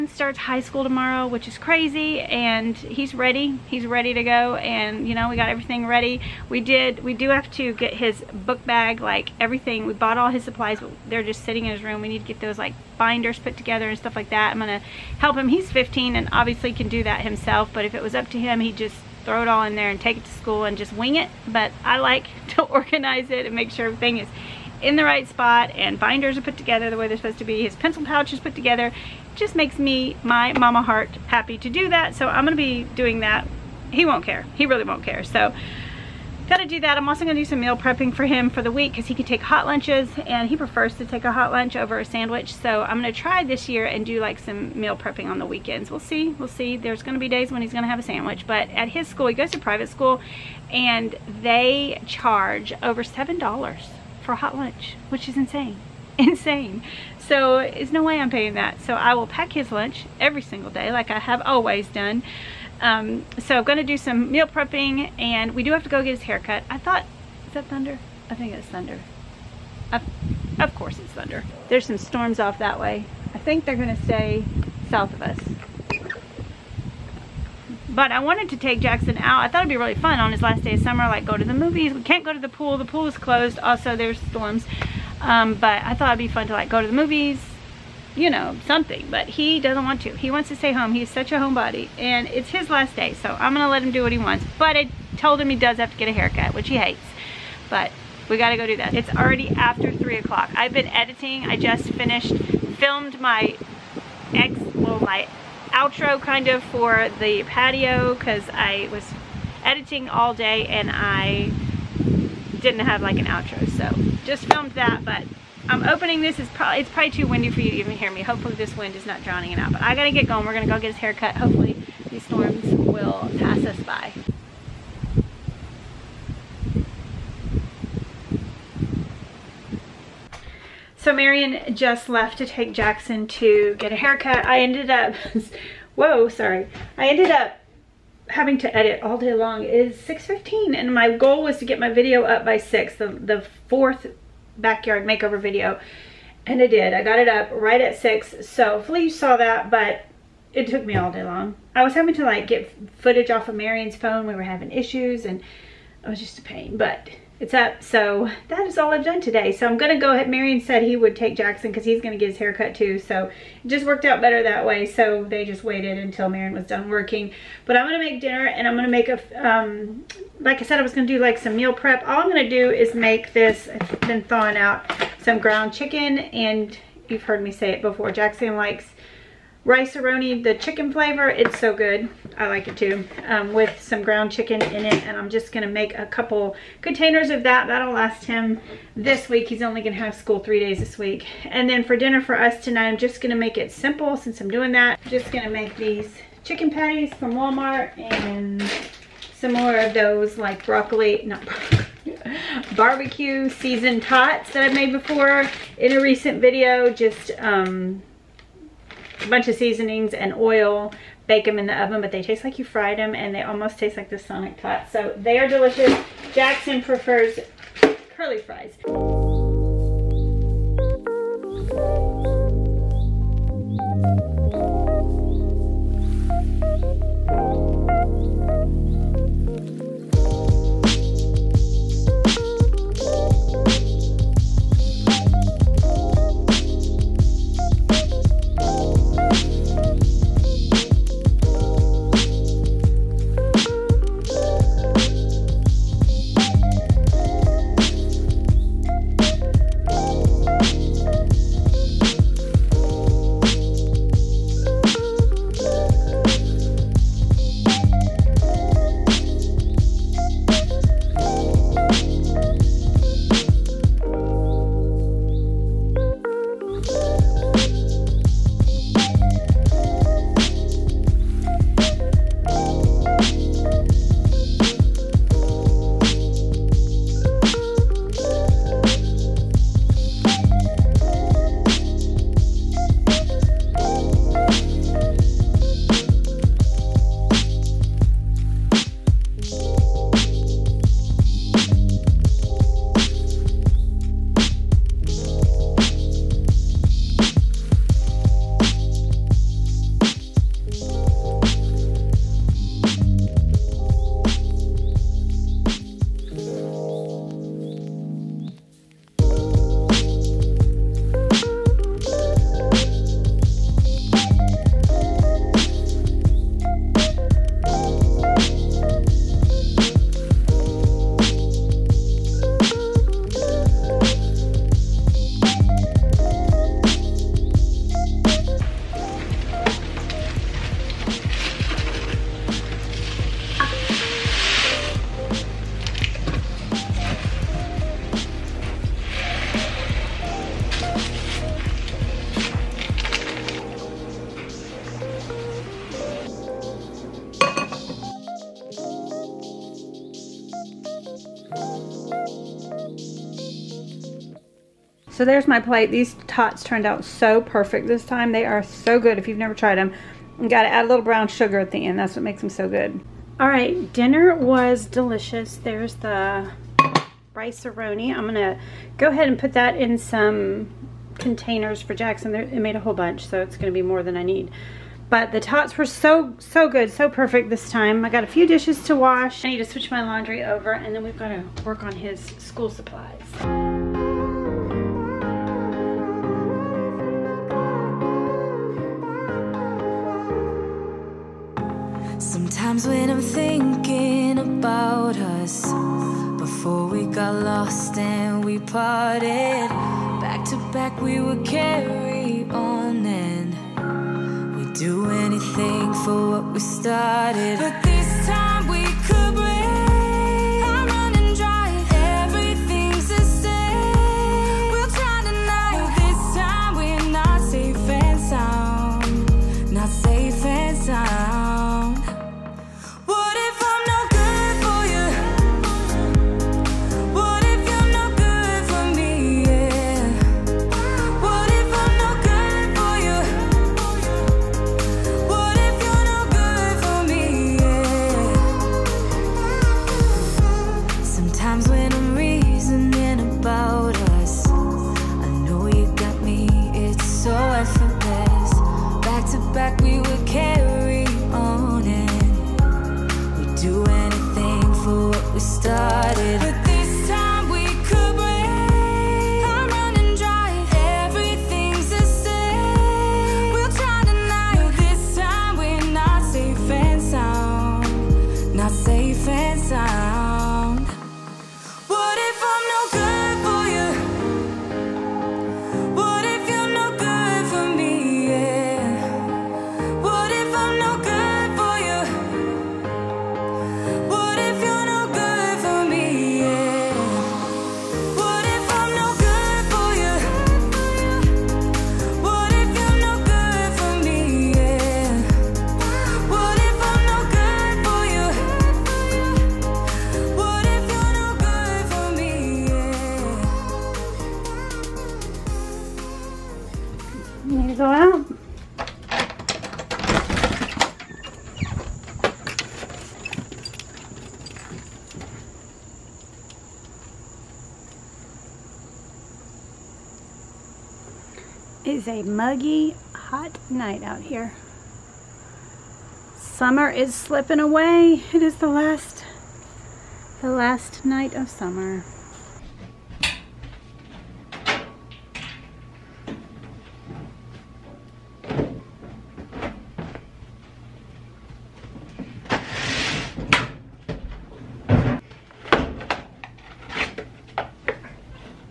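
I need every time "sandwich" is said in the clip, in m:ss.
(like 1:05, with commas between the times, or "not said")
0:42, 0:48.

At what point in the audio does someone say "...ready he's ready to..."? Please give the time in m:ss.
0:03.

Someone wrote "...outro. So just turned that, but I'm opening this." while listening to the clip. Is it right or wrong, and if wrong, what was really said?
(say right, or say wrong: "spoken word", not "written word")
wrong: "filmed", not "turned".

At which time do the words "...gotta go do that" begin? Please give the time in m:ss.
1:38.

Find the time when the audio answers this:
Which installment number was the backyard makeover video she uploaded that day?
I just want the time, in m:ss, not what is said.
2:23.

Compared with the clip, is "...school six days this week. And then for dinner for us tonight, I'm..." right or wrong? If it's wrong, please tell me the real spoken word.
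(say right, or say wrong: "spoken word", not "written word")
wrong: "three", not "six".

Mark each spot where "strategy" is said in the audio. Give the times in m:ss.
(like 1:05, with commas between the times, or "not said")
not said.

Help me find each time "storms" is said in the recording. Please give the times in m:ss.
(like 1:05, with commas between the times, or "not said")
1:11, 1:24, 2:02.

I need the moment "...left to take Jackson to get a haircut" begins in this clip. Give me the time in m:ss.
2:12.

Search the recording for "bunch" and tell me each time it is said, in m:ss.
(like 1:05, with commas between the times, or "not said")
3:29, 6:12.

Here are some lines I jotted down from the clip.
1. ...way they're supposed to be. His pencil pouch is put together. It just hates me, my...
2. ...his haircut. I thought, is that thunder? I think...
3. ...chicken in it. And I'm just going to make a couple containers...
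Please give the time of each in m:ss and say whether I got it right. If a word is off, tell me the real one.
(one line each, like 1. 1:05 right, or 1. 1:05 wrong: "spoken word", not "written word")
1. 0:26 wrong: "makes", not "hates"
2. 1:06 right
3. 3:04 right.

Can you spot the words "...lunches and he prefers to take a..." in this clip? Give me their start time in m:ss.
0:39.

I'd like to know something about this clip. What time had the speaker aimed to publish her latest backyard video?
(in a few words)
6.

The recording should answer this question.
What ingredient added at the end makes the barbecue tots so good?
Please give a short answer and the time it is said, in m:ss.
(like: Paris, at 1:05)
brown sugar, at 6:01.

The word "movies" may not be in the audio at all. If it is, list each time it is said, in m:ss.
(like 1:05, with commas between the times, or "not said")
1:21, 1:26.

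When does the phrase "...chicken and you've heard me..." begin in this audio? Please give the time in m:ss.
2:55.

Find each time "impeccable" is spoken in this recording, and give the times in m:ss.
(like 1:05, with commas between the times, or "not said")
not said.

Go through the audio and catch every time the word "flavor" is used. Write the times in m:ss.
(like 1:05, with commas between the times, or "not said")
3:00.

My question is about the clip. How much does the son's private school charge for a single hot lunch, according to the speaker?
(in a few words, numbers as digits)
over $7.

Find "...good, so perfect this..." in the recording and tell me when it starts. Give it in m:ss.
6:16.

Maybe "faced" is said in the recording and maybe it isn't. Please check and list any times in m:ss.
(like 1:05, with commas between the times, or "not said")
not said.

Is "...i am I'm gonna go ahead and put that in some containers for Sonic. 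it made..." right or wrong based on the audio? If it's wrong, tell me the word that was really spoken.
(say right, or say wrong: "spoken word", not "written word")
wrong: "Jackson", not "Sonic".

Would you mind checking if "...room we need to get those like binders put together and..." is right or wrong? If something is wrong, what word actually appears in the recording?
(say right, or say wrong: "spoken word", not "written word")
right.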